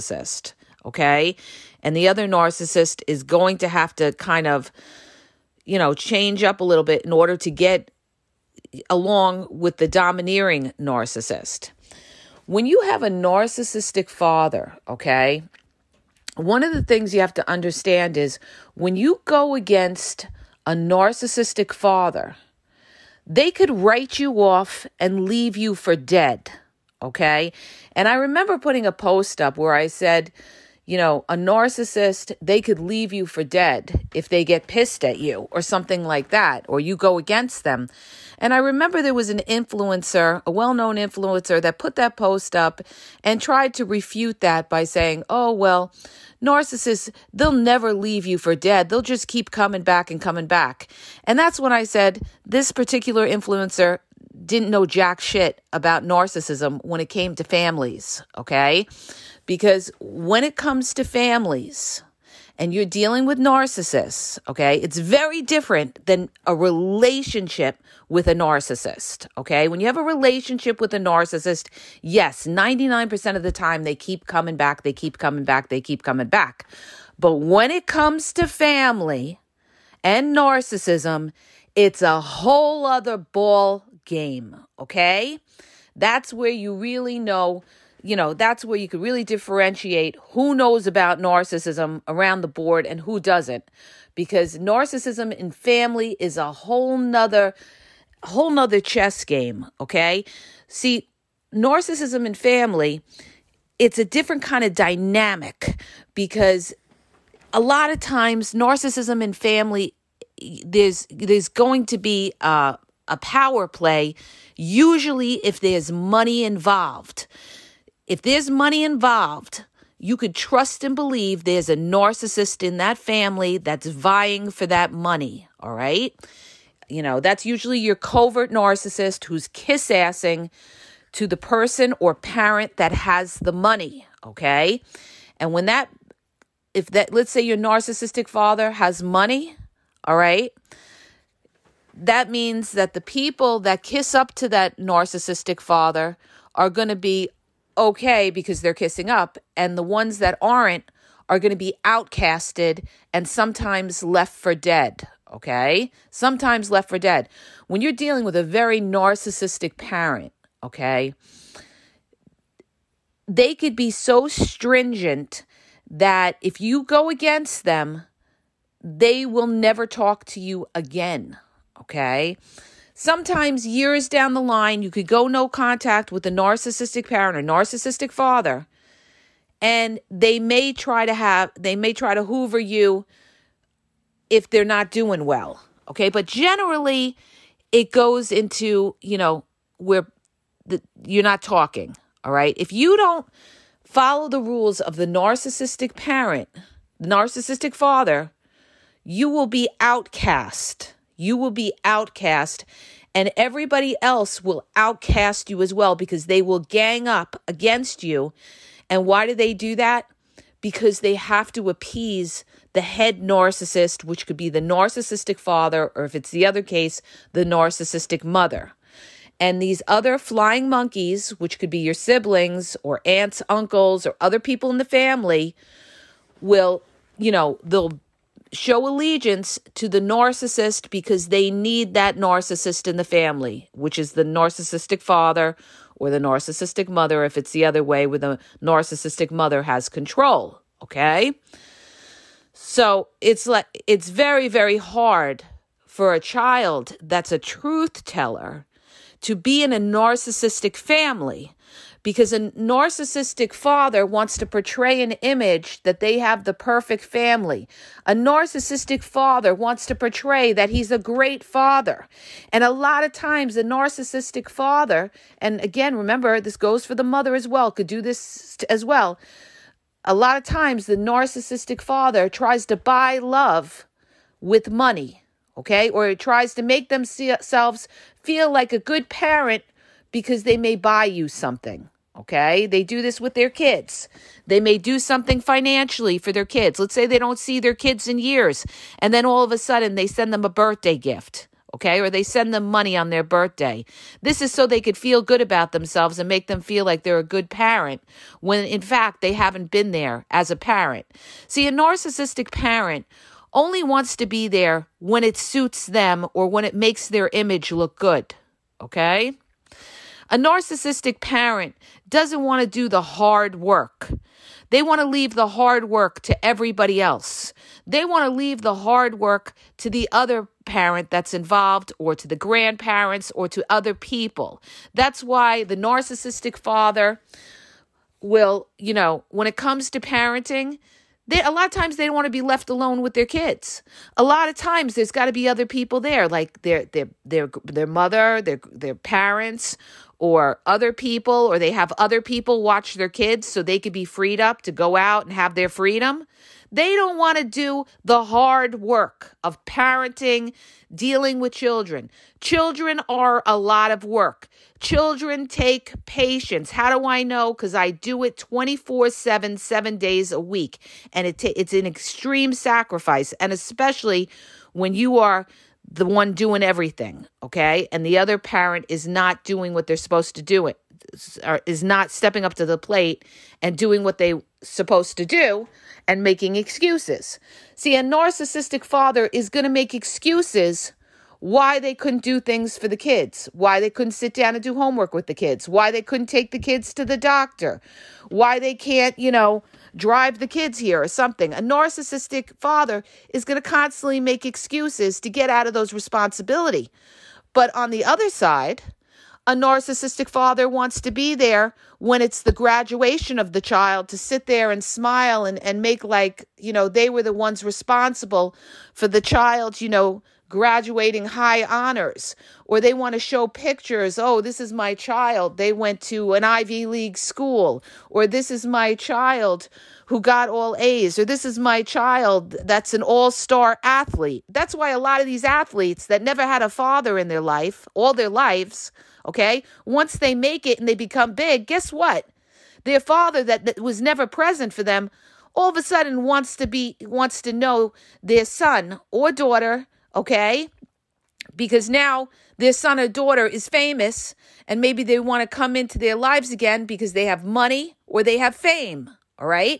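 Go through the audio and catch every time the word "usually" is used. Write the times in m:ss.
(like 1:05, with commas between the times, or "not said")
1:54, 2:07.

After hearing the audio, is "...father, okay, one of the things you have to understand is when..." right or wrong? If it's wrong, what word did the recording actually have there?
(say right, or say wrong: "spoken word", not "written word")
right.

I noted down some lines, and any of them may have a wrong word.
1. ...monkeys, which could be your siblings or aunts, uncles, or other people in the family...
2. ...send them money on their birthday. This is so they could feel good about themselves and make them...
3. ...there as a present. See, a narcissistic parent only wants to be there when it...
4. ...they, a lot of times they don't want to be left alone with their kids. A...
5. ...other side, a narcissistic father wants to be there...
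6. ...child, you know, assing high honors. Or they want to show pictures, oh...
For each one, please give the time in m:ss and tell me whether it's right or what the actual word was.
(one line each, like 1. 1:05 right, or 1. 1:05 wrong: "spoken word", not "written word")
1. 3:40 right
2. 4:52 right
3. 4:59 wrong: "parent", not "present"
4. 5:31 right
5. 6:38 right
6. 6:49 wrong: "graduating", not "assing".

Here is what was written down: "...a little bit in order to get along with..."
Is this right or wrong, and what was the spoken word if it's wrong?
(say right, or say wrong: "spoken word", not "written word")
right.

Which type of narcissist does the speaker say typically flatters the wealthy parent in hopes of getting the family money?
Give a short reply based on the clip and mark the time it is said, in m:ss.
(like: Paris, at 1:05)
covert narcissist, at 2:07.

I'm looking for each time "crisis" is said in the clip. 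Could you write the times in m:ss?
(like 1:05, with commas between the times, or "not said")
not said.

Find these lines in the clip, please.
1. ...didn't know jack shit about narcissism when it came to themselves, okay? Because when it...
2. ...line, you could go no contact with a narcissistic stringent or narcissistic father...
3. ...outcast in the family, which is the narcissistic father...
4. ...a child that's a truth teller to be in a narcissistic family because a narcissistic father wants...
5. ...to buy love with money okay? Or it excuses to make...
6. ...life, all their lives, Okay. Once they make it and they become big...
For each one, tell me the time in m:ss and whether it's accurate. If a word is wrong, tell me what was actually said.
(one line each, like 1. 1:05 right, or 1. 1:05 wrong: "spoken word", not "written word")
1. 0:54 wrong: "families", not "themselves"
2. 2:54 wrong: "parent", not "stringent"
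3. 3:52 wrong: "narcissist", not "outcast"
4. 4:06 right
5. 4:32 wrong: "tries", not "excuses"
6. 7:07 right.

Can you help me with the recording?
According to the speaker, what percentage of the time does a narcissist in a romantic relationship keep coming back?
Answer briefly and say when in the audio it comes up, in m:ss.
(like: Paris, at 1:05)
99%, at 1:12.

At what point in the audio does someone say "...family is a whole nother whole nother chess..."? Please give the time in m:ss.
1:35.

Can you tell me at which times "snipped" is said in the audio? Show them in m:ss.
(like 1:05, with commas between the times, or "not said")
not said.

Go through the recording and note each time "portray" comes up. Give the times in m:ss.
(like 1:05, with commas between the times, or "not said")
4:14, 4:19.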